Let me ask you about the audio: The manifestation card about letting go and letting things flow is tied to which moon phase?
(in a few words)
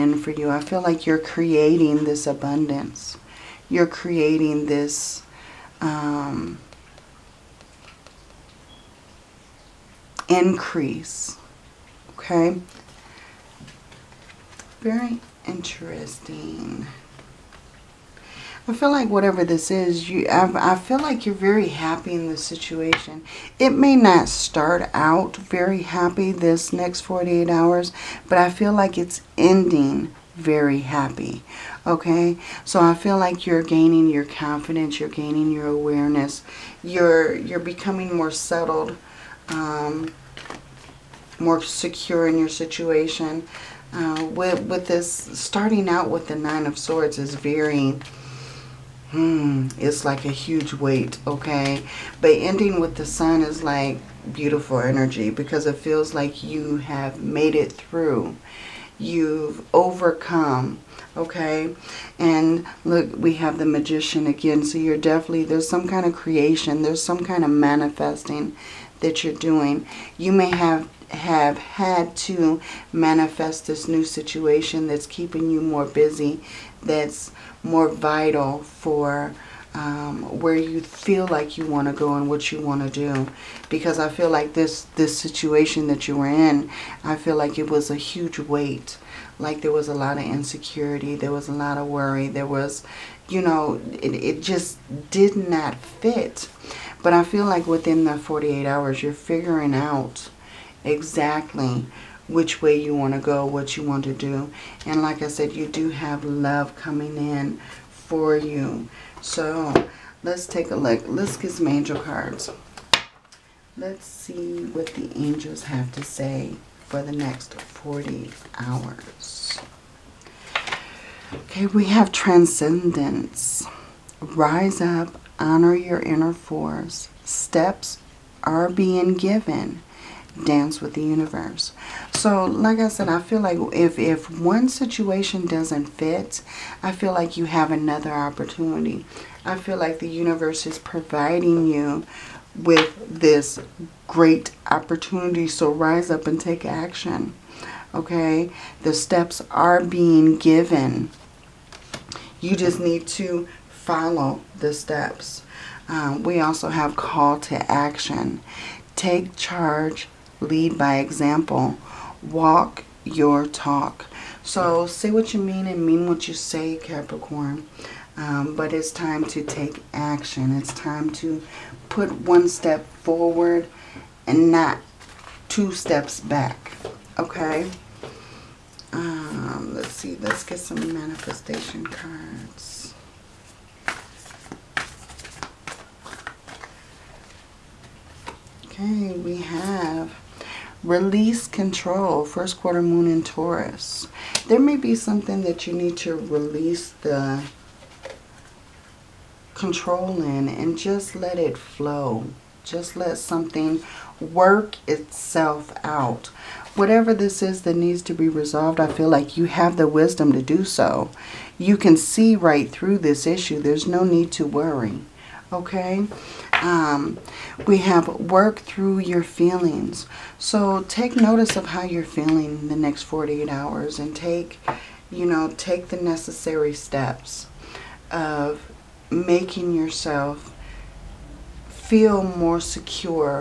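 first quarter moon.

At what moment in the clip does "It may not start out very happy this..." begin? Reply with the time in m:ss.
0:23.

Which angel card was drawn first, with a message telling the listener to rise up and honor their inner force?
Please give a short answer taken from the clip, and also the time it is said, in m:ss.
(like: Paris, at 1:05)
Transcendence, at 2:02.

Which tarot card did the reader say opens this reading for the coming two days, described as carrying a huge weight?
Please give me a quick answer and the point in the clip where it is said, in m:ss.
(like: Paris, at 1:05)
Nine of Swords, at 0:46.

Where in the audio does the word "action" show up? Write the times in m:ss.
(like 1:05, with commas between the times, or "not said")
2:26, 2:37, 2:49.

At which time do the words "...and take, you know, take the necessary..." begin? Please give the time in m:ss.
3:43.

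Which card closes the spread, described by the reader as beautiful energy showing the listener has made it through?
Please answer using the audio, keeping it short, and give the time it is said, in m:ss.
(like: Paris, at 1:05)
the Sun, at 0:52.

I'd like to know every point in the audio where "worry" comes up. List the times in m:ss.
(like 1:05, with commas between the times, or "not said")
1:31, 3:34.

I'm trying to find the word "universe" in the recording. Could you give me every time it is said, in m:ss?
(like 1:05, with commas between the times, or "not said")
2:11, 2:20.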